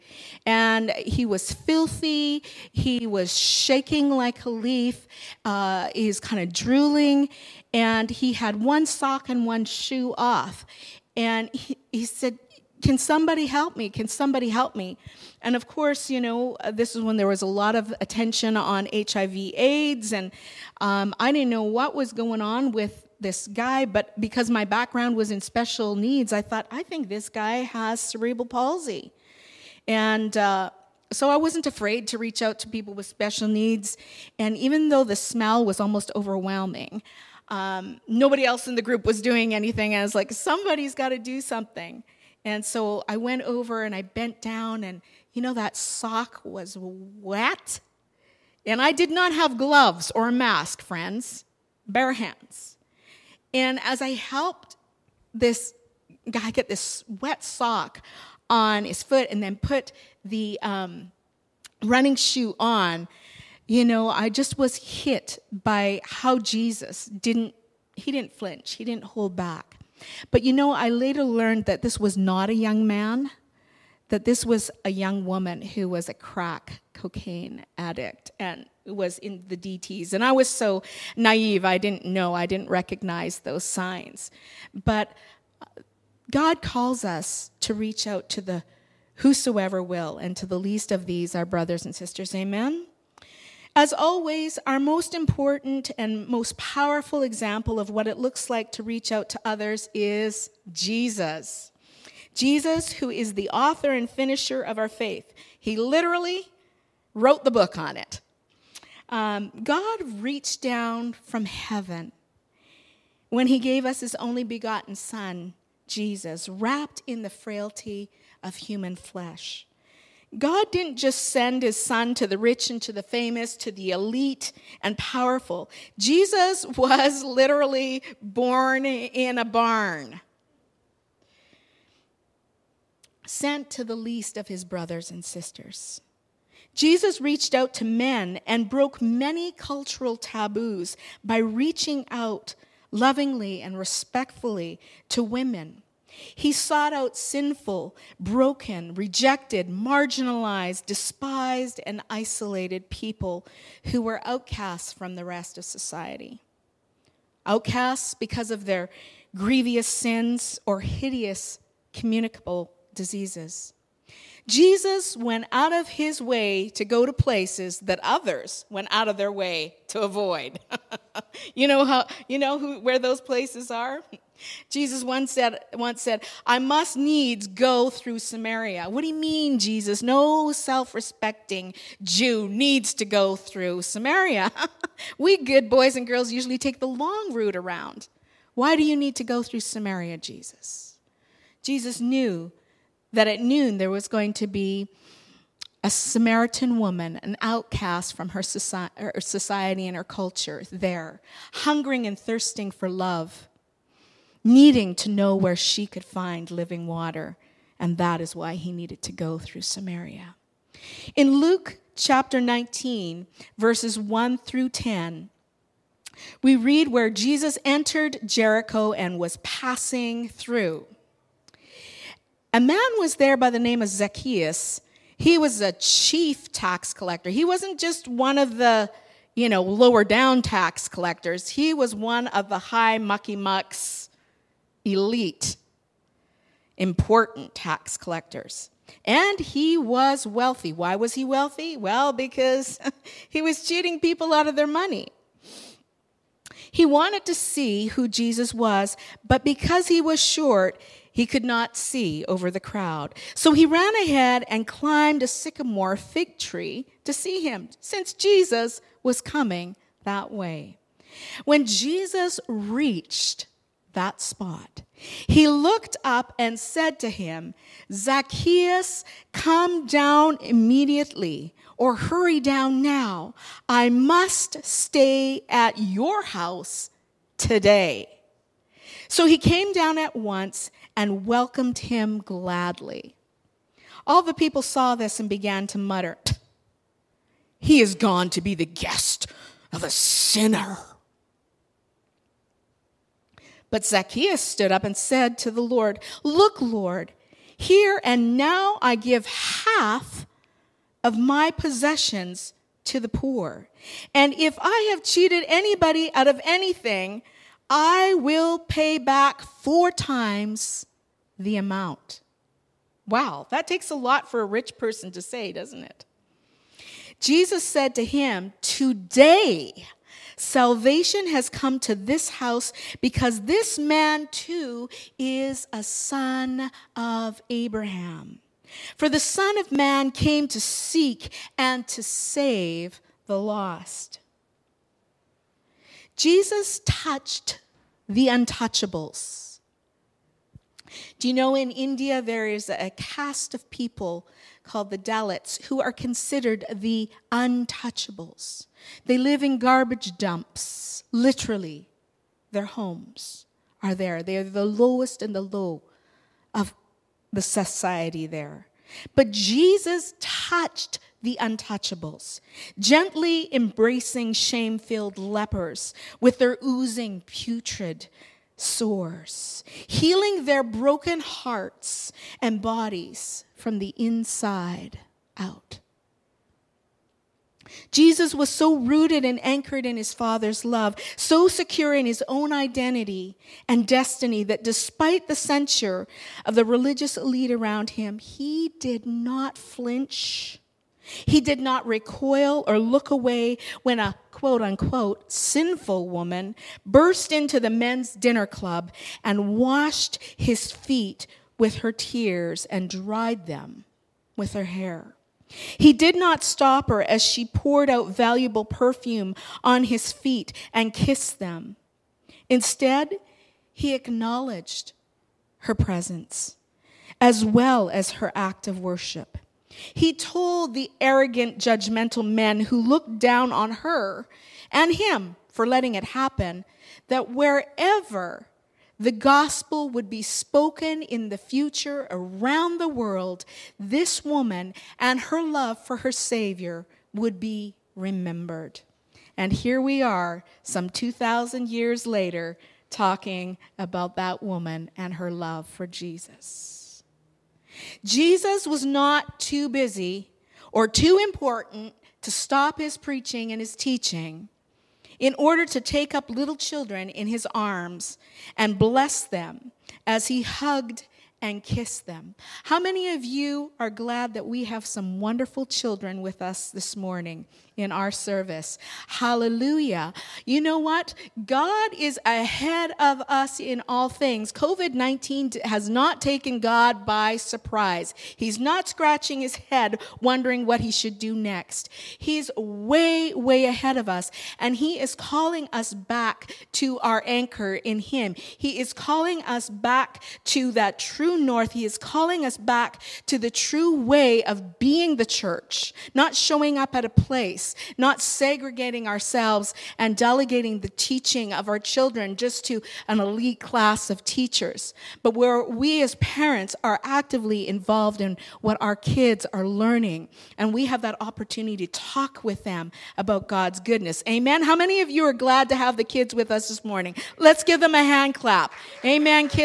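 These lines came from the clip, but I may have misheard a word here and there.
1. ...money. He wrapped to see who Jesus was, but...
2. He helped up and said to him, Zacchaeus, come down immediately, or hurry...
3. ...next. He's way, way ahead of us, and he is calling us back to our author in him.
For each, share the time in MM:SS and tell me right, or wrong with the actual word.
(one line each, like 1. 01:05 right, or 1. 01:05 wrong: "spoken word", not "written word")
1. 04:04 wrong: "wanted", not "wrapped"
2. 04:25 wrong: "looked", not "helped"
3. 08:01 wrong: "anchor", not "author".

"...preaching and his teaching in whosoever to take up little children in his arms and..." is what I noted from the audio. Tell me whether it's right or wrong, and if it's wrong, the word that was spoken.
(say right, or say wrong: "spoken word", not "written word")
wrong: "order", not "whosoever".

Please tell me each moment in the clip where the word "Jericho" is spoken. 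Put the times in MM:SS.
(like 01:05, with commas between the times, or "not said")
03:38.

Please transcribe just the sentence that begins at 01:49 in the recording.
Um, God reached down from heaven when he gave us his only begotten Son, Jesus, wrapped in the frailty of human flesh.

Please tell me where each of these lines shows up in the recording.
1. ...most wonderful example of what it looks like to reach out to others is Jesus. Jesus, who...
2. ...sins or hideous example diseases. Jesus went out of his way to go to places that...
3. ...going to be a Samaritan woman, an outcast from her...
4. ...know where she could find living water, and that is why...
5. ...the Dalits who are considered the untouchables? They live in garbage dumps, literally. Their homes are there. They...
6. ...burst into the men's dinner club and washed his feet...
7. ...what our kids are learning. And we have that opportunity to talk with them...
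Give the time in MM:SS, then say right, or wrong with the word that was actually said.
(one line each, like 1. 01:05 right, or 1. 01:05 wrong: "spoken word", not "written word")
1. 01:36 wrong: "powerful", not "wonderful"
2. 02:39 wrong: "communicable", not "example"
3. 03:14 right
4. 03:25 right
5. 05:44 right
6. 06:36 right
7. 08:28 right.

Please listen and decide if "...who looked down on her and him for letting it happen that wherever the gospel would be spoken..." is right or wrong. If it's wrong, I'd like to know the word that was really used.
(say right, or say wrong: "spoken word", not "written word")
right.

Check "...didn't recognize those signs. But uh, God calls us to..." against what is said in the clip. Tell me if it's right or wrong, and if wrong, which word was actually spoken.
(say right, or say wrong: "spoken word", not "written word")
right.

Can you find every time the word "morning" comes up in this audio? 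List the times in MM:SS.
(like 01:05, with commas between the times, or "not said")
07:46, 08:36.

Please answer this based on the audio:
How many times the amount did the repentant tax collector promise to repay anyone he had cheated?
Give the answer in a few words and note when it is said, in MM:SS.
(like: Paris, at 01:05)
4, at 05:09.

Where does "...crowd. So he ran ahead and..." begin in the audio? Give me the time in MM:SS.
04:12.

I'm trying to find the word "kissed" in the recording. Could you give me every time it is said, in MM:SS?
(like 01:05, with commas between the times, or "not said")
06:50, 07:41.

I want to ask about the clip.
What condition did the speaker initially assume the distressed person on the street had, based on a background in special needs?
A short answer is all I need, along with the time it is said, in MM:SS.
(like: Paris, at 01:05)
cerebral palsy, at 00:28.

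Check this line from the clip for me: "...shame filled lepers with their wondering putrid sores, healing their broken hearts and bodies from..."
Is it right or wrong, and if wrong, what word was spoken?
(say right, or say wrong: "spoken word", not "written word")
wrong: "oozing", not "wondering".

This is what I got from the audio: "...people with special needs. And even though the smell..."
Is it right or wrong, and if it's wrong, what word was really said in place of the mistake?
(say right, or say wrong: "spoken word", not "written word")
right.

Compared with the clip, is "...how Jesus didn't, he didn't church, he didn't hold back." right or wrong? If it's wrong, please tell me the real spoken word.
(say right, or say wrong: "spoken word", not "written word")
wrong: "flinch", not "church".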